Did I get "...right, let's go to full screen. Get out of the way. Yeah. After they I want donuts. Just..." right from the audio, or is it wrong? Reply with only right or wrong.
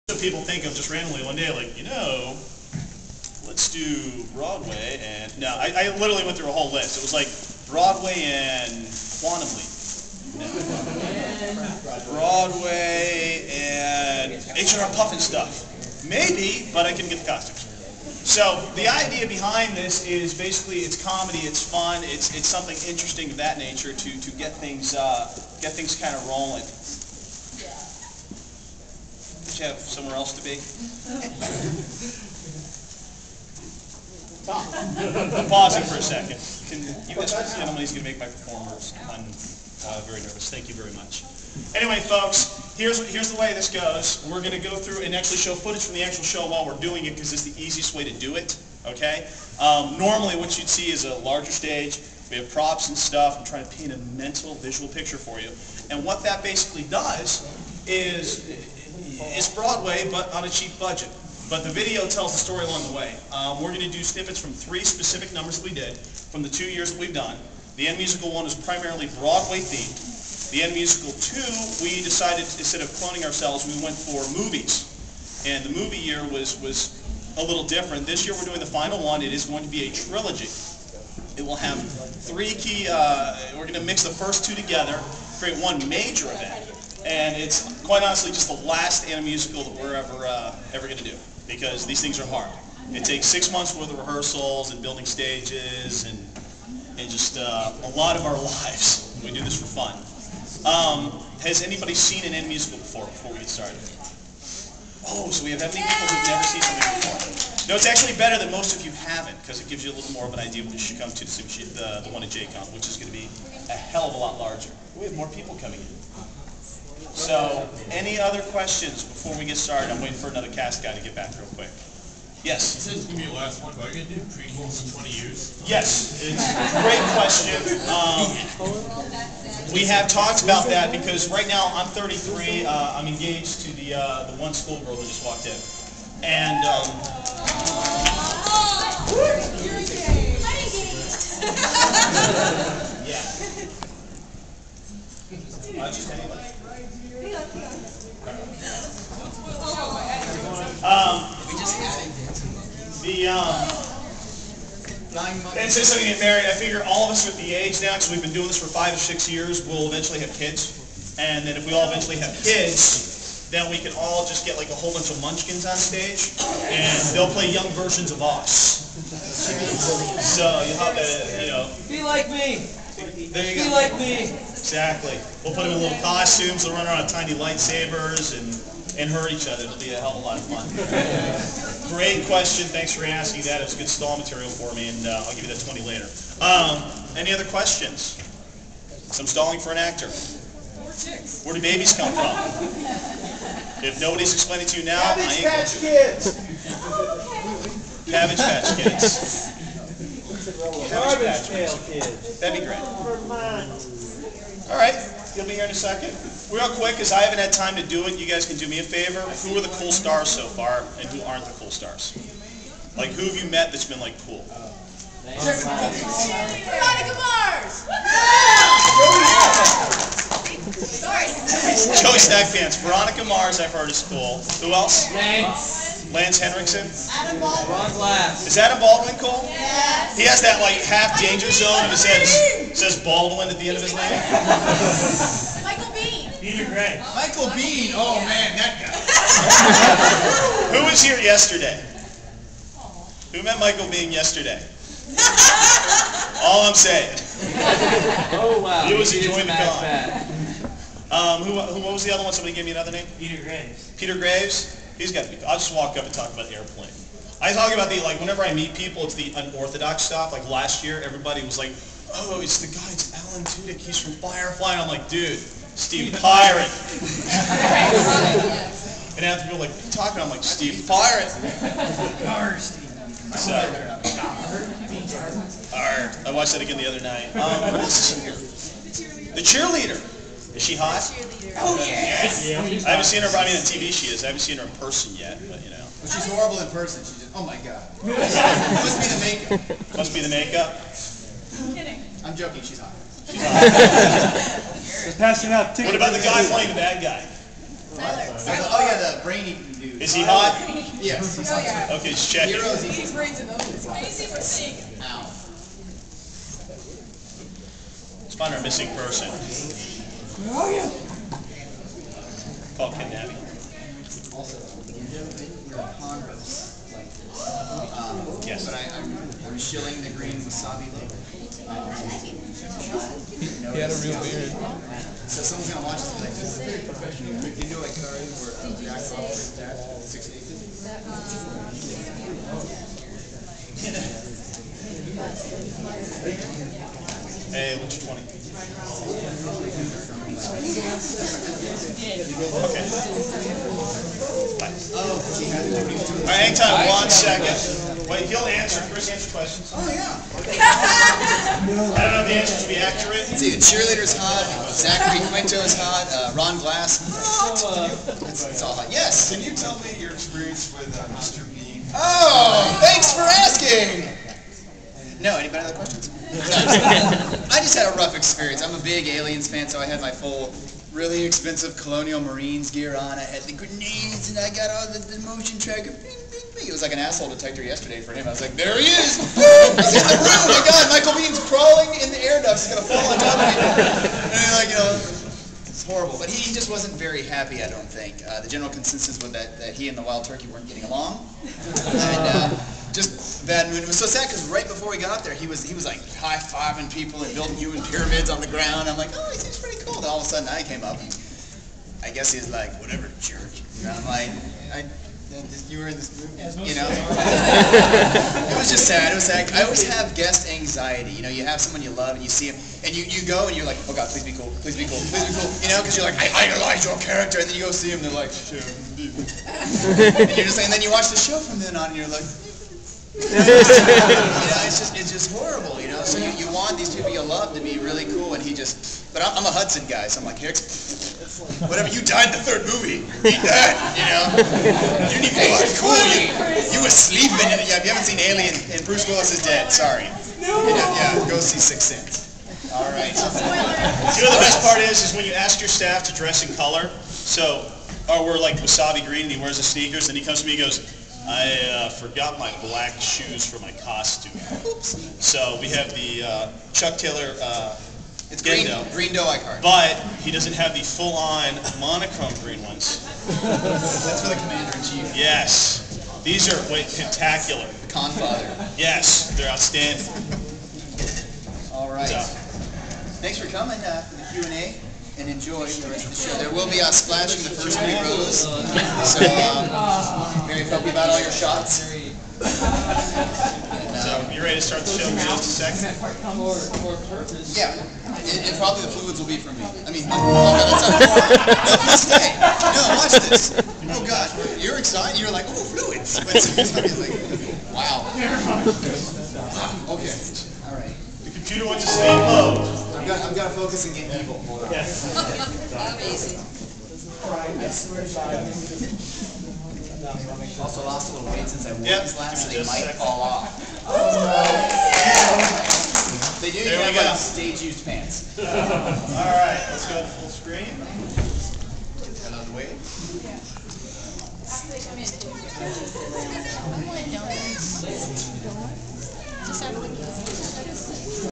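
right.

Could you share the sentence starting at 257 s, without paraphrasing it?
I talk about the, like, whenever I meet people, it's the unorthodox stuff.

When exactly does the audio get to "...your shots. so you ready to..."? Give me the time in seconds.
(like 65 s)
481 s.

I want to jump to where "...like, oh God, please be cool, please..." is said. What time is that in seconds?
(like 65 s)
413 s.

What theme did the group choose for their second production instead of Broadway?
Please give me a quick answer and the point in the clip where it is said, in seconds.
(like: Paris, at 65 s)
Movies, at 74 s.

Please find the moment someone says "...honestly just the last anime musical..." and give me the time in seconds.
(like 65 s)
88 s.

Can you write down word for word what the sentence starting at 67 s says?
The Animusical one is primarily Broadway themed.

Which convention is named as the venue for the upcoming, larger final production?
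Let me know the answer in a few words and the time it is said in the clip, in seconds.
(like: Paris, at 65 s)
JCon, at 112 s.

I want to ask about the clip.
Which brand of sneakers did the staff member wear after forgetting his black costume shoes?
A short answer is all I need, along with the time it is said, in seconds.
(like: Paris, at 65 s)
Chuck Taylor, at 456 s.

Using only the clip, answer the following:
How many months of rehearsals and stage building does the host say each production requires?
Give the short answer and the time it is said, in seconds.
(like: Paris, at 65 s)
6, at 93 s.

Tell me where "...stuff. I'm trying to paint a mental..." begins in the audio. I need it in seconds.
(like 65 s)
52 s.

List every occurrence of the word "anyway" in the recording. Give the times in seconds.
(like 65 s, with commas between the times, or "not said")
41 s, 146 s.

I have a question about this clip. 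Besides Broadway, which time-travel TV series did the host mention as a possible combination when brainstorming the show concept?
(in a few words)
Quantum Leap.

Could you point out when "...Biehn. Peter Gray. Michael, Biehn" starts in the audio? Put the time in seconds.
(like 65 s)
235 s.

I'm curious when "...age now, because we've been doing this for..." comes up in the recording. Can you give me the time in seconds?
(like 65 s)
157 s.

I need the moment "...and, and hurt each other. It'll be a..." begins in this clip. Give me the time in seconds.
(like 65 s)
178 s.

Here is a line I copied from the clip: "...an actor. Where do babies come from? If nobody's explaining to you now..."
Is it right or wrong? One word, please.
right.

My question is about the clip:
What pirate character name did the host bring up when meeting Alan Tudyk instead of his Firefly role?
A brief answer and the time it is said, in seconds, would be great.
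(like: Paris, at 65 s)
Steve Pirate, at 270 s.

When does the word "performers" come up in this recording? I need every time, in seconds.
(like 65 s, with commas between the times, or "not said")
38 s.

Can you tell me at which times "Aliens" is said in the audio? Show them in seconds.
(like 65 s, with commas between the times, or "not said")
369 s, 438 s.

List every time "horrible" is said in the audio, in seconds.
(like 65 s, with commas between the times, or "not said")
286 s, 385 s, 425 s.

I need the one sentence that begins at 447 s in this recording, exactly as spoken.
So, or oh, we're like wasabi green, and he wears the sneakers, and he comes to me, and goes.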